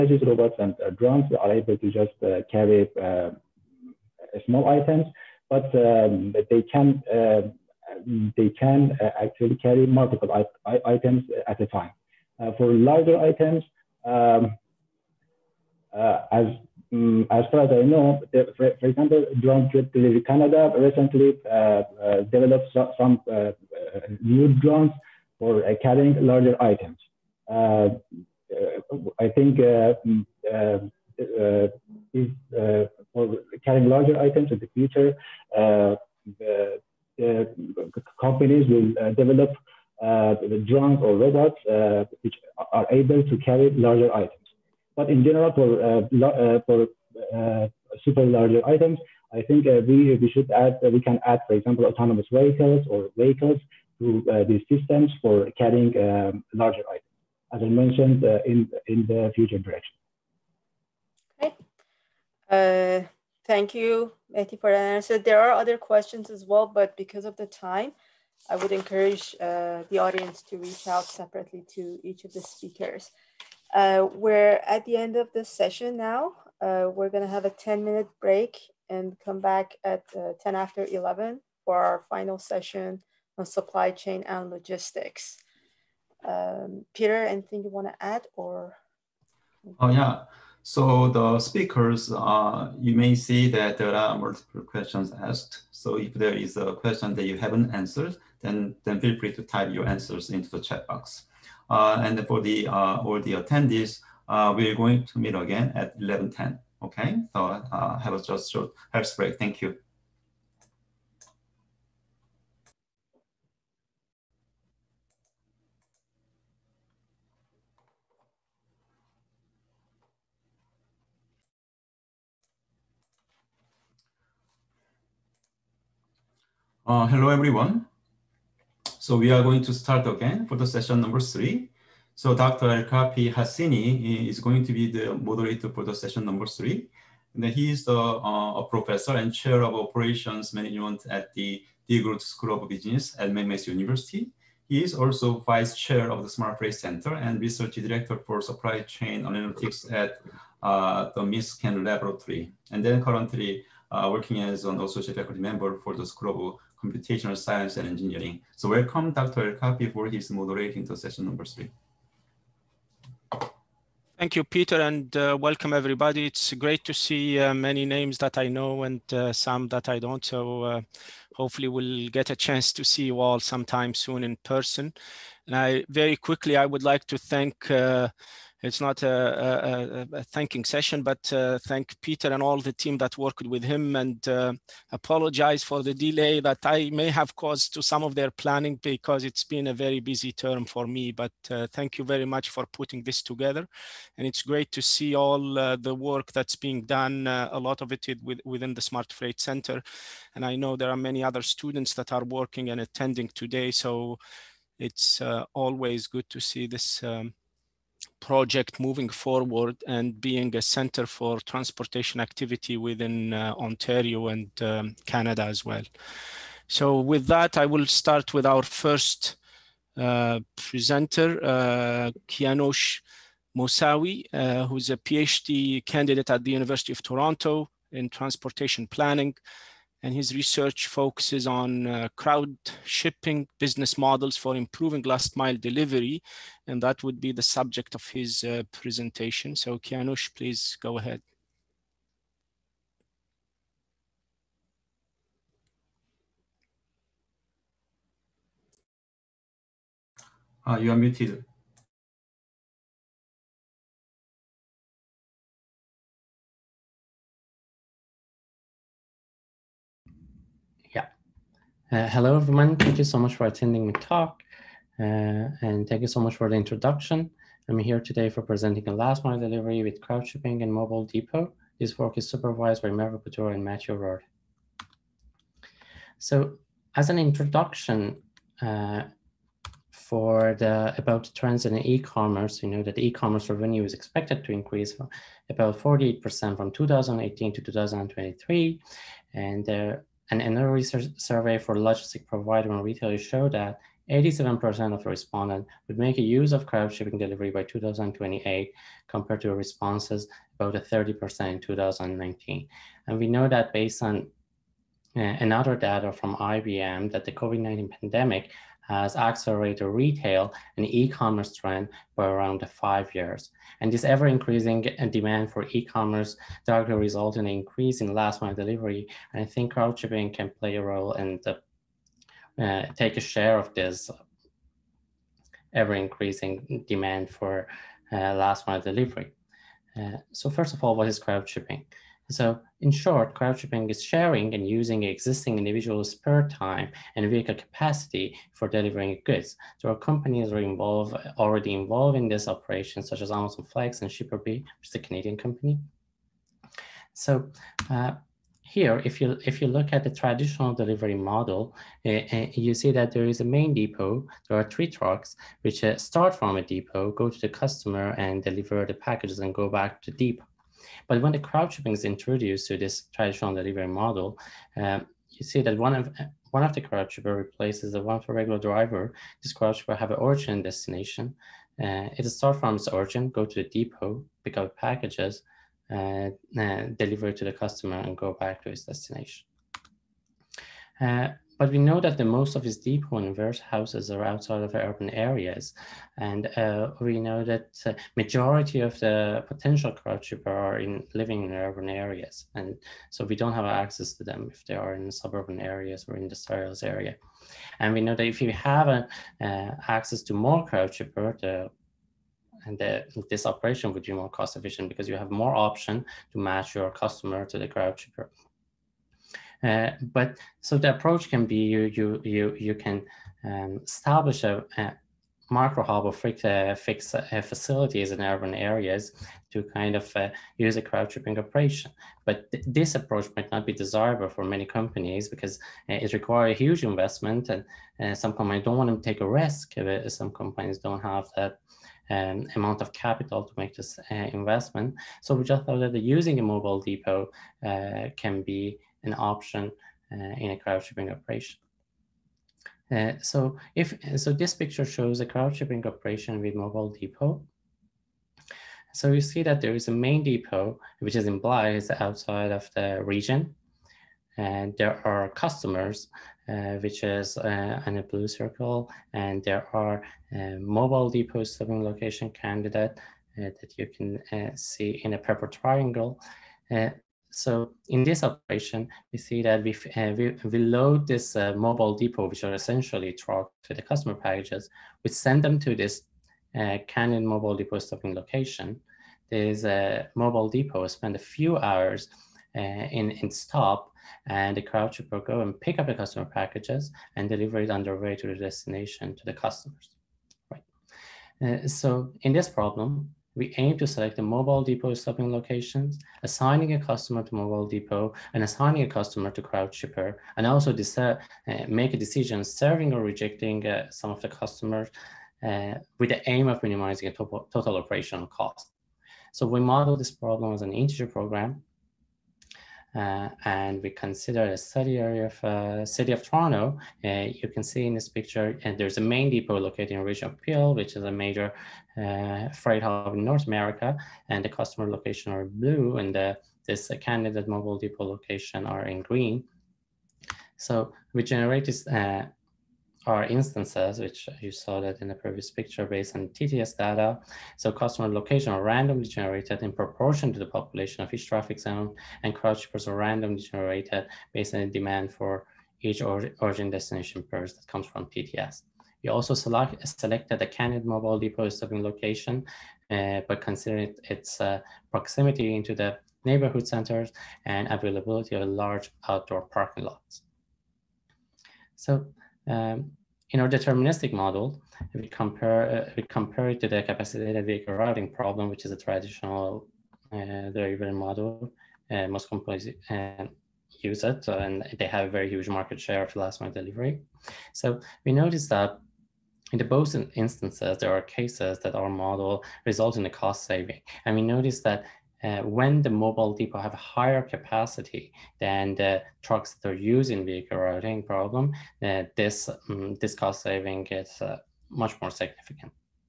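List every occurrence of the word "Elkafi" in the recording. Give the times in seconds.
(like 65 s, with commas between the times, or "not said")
132 s.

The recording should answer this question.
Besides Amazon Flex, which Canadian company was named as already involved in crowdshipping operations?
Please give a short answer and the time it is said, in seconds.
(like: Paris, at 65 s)
Shipperbee, at 344 s.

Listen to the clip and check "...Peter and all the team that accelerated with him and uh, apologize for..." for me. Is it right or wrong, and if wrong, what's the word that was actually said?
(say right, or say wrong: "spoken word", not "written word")
wrong: "worked", not "accelerated".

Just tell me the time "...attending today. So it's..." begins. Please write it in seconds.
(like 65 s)
202 s.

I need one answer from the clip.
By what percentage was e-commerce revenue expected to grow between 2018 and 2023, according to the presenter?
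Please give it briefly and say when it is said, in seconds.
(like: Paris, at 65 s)
48%, at 285 s.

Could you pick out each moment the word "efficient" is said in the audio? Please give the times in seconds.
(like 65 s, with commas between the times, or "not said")
404 s.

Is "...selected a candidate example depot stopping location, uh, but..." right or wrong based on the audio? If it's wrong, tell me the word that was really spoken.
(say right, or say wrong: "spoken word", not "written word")
wrong: "mobile", not "example".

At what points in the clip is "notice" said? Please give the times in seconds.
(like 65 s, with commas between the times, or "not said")
578 s, 584 s.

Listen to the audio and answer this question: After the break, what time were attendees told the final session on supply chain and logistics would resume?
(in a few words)
11:10.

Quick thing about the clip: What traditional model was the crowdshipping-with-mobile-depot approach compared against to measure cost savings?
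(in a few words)
capacitated vehicle routing problem.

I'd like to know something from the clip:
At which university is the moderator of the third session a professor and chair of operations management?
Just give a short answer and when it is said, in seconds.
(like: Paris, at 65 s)
McMaster University, at 143 s.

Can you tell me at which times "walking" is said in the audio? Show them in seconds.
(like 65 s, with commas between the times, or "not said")
not said.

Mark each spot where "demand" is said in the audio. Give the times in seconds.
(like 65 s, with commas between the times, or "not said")
315 s, 326 s, 544 s.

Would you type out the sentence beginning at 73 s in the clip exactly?
we're at the end of this session now.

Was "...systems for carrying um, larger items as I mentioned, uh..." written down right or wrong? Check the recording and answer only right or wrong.
right.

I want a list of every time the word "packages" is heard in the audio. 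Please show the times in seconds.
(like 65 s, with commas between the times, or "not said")
358 s, 374 s, 474 s, 486 s.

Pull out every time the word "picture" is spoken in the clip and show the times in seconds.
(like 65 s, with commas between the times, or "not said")
444 s, 518 s, 535 s.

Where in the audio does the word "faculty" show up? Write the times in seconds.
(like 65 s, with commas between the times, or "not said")
155 s.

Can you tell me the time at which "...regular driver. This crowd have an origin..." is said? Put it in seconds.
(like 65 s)
368 s.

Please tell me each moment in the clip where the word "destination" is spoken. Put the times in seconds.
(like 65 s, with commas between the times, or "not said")
370 s, 378 s, 488 s, 546 s.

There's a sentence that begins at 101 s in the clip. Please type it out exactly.
Uh, and for the uh, all the attendees, uh, we're going to meet again at 11.10.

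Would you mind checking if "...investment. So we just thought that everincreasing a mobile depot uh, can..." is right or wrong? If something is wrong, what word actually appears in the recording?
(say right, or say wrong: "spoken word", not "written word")
wrong: "using", not "everincreasing".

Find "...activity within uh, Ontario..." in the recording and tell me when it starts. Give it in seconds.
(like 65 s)
212 s.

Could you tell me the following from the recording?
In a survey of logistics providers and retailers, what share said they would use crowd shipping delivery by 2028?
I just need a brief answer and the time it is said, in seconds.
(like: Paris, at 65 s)
87%, at 294 s.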